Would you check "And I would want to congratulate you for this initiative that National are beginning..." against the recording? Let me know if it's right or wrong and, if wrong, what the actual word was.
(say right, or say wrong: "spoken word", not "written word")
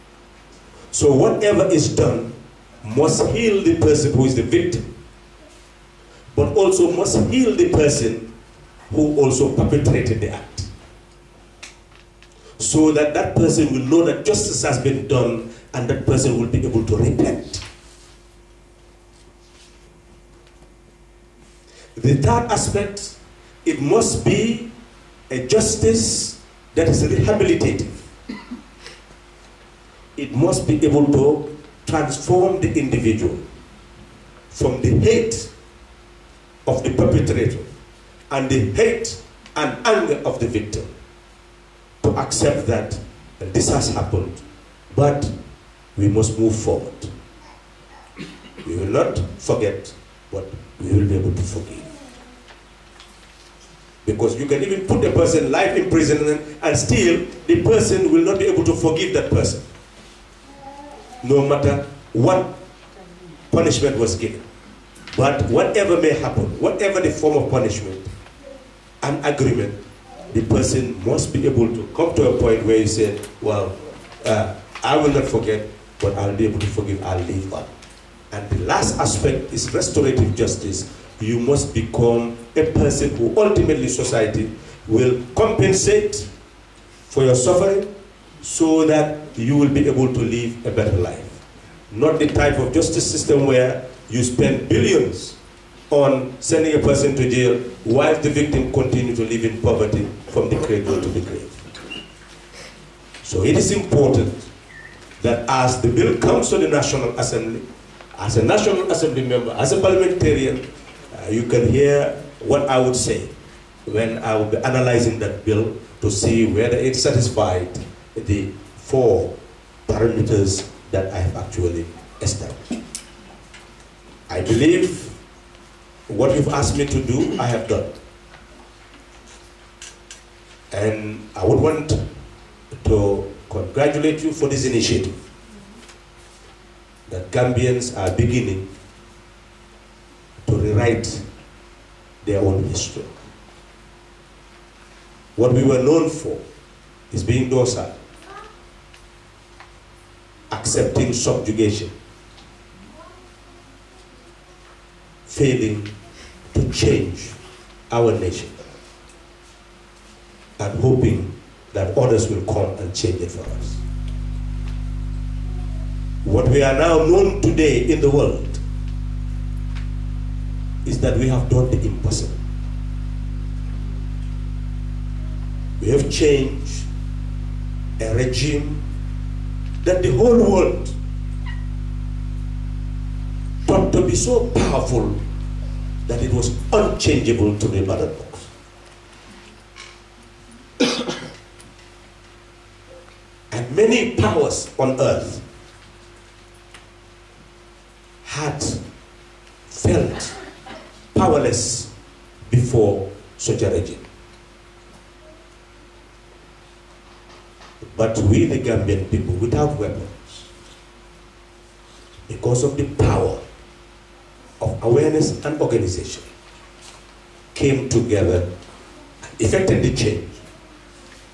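wrong: "Gambians", not "National".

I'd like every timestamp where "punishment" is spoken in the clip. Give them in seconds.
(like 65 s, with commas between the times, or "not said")
63 s, 67 s.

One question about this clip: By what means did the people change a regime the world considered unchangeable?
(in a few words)
The ballot box.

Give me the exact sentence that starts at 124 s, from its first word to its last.
I believe what you've asked me to do, I have done.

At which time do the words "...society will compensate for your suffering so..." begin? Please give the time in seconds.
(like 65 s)
83 s.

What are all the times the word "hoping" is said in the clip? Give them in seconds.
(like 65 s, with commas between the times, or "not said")
160 s.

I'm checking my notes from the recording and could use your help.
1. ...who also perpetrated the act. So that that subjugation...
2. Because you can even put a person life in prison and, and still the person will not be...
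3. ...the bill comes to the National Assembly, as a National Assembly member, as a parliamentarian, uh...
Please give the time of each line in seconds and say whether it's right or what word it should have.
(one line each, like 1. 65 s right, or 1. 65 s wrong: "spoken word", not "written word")
1. 8 s wrong: "person", not "subjugation"
2. 54 s right
3. 105 s right.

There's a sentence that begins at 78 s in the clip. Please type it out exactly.
And the last aspect is restorative justice.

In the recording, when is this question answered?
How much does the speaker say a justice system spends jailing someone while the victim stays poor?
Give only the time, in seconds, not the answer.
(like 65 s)
94 s.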